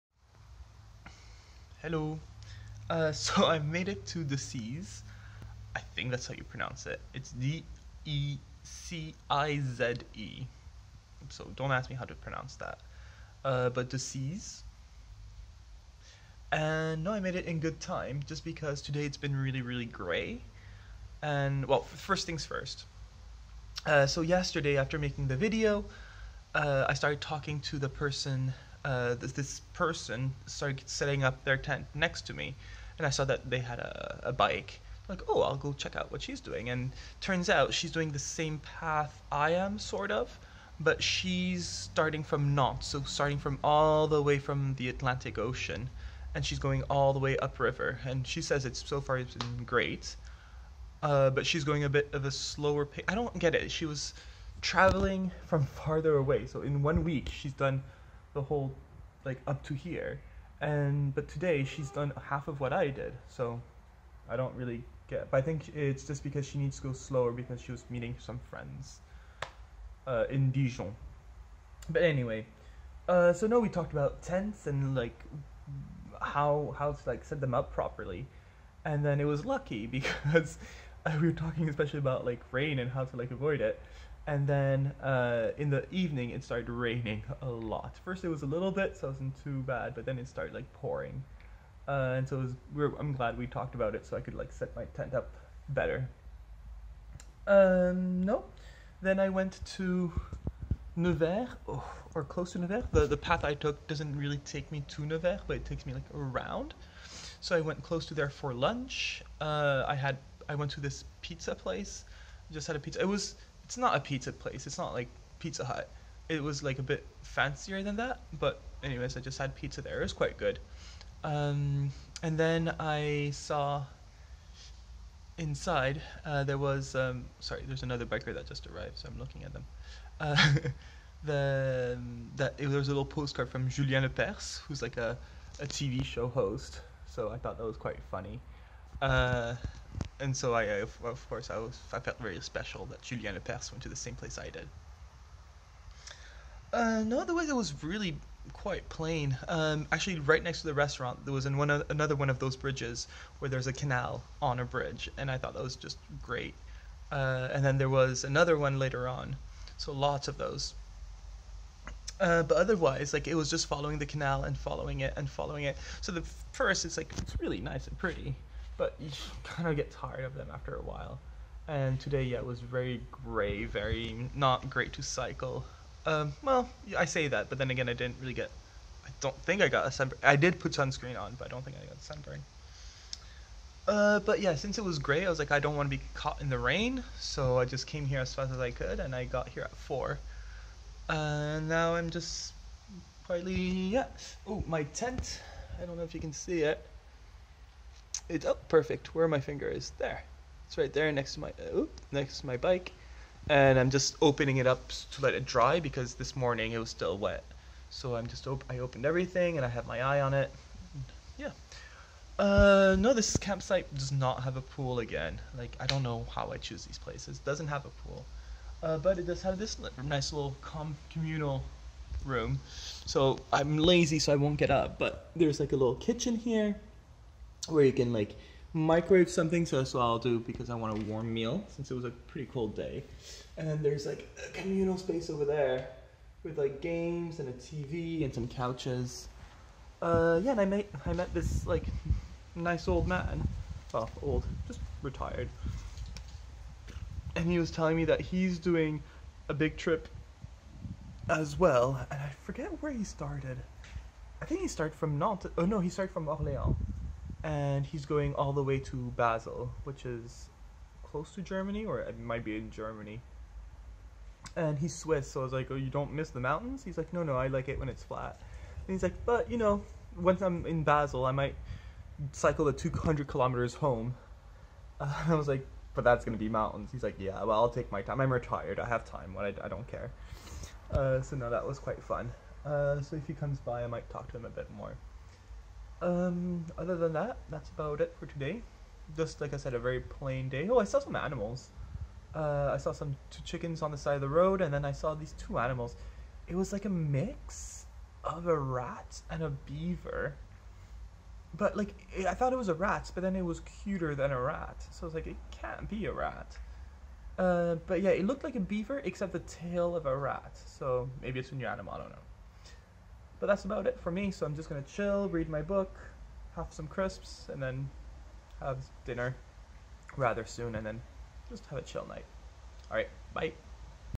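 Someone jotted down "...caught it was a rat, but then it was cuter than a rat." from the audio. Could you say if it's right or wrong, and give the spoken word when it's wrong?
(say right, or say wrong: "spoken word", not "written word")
wrong: "thought", not "caught".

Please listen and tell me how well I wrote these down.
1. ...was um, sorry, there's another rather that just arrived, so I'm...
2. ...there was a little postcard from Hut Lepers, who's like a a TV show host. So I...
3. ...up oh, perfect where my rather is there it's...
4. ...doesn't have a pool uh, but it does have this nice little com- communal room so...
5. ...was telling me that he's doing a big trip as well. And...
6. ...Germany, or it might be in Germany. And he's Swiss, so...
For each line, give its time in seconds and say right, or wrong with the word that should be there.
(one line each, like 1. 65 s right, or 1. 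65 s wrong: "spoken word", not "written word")
1. 126 s wrong: "biker", not "rather"
2. 132 s wrong: "Julien", not "Hut"
3. 198 s wrong: "finger", not "rather"
4. 217 s right
5. 247 s right
6. 261 s right.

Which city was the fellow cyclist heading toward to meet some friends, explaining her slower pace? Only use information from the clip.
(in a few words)
Dijon.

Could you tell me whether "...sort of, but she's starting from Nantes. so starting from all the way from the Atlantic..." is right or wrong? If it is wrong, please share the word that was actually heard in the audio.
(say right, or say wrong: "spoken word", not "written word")
right.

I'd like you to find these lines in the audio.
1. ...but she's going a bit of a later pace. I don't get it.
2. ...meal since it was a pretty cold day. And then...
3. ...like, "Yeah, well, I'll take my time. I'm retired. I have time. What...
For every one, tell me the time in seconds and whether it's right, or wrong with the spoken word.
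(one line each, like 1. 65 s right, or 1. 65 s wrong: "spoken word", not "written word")
1. 51 s wrong: "slower", not "later"
2. 231 s right
3. 277 s right.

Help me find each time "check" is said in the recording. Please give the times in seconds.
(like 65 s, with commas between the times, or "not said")
35 s.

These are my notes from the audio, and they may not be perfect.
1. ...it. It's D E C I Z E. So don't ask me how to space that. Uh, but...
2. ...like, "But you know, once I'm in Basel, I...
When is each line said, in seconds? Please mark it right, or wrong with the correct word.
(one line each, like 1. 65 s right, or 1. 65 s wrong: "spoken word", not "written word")
1. 6 s wrong: "pronounce", not "space"
2. 269 s right.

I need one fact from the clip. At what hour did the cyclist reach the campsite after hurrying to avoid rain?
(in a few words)
4.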